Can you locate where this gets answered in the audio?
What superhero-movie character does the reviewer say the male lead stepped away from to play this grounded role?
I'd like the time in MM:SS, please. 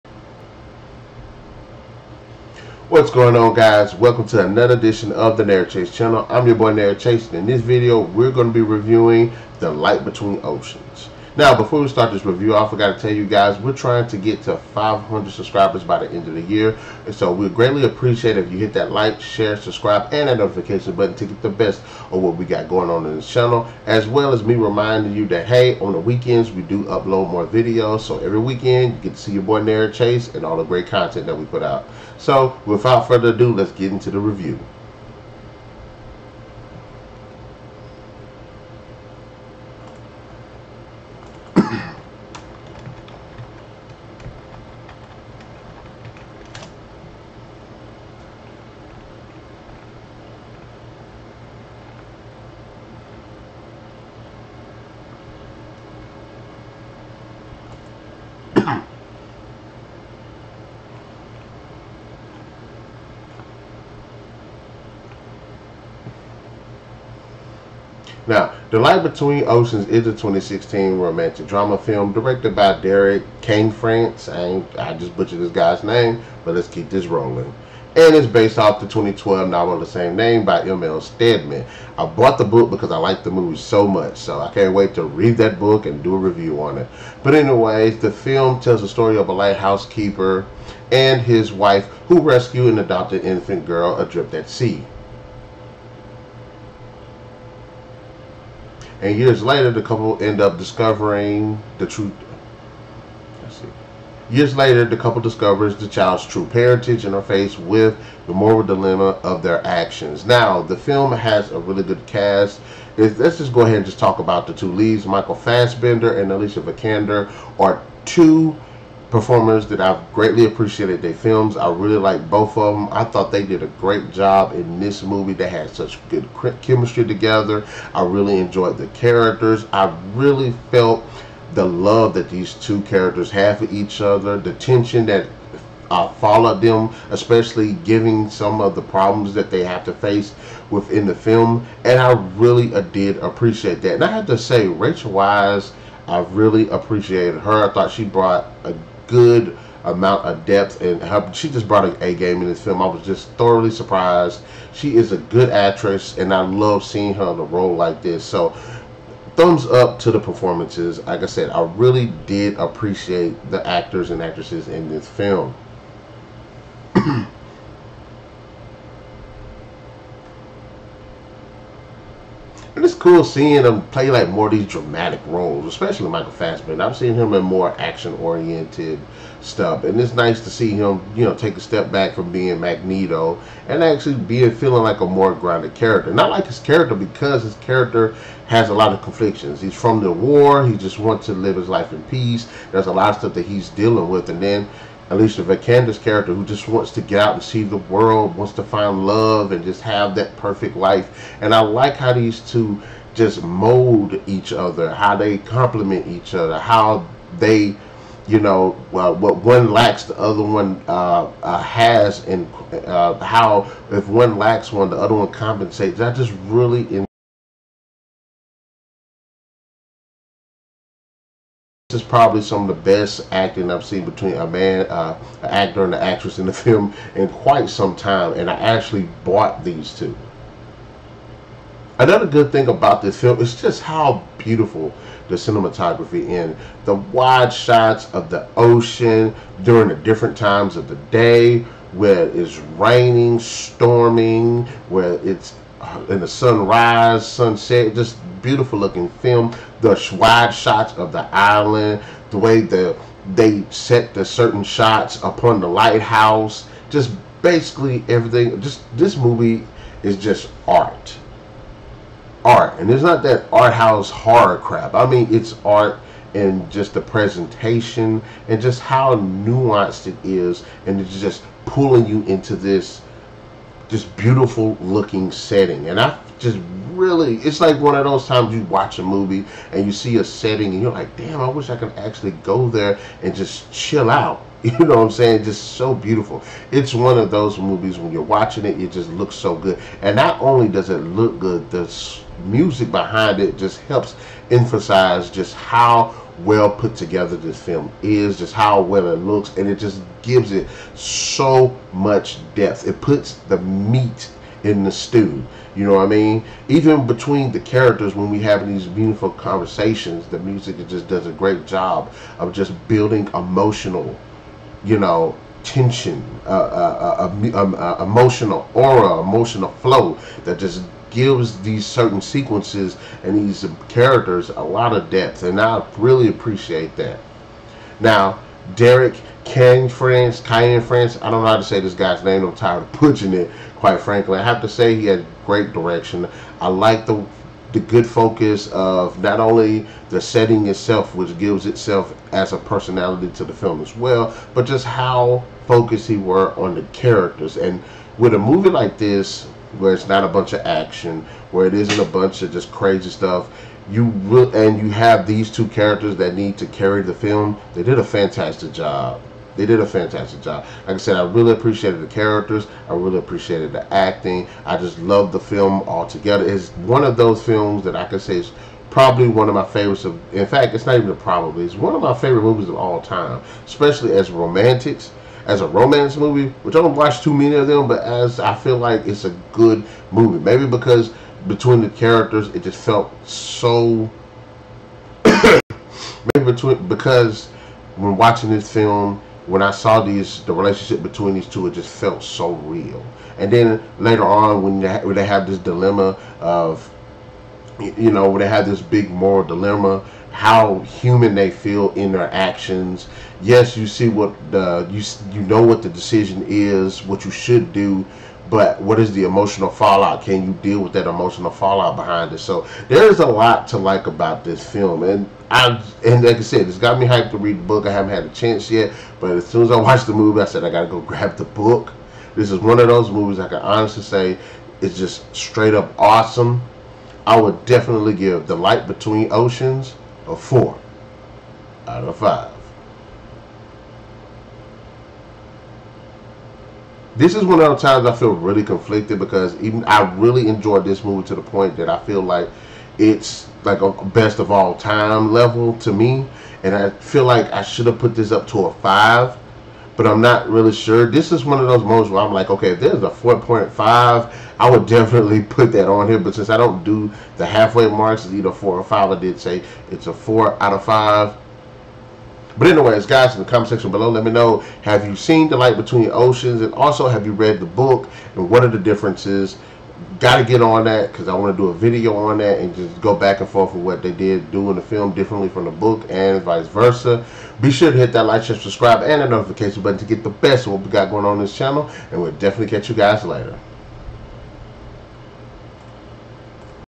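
03:02.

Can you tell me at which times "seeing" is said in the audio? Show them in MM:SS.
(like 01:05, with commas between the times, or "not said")
02:36, 02:53.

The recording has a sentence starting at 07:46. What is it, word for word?
And also, have you read the book?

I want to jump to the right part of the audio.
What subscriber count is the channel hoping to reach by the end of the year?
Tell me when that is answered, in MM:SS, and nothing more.
00:14.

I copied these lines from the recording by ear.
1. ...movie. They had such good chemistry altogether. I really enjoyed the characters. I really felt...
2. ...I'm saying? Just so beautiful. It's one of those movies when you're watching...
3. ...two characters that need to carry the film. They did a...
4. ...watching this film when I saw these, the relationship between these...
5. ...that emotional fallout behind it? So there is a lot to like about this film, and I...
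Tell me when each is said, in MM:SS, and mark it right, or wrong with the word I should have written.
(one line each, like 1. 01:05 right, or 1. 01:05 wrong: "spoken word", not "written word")
1. 02:05 wrong: "together", not "altogether"
2. 04:45 right
3. 05:55 right
4. 06:28 right
5. 06:50 right.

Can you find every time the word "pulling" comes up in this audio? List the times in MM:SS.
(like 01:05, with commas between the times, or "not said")
04:31.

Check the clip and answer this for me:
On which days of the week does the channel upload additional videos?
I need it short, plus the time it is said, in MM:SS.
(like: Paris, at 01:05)
weekends, at 00:25.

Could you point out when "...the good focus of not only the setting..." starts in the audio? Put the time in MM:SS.
05:37.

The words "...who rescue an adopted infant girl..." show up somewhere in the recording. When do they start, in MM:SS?
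01:32.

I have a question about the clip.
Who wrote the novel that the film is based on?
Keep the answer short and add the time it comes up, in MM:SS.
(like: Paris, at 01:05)
M.L. Stedman, at 01:20.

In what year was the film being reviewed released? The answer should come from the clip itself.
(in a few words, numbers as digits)
2016.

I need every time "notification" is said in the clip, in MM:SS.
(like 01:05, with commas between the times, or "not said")
00:20, 07:59.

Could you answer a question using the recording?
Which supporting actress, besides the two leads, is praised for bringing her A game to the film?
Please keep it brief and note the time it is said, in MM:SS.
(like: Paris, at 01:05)
Rachel Weisz, at 02:24.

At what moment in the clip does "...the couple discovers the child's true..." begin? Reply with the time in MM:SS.
01:44.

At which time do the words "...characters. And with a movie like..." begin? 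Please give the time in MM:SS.
05:46.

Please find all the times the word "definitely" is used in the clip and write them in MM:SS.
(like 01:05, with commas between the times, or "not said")
07:07, 07:34, 08:02.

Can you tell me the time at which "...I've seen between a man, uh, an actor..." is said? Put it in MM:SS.
03:43.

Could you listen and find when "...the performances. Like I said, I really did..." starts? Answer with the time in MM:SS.
02:40.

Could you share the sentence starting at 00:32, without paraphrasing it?
So without further ado, let's get into the review.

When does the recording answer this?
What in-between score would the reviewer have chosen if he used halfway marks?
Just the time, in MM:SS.
07:33.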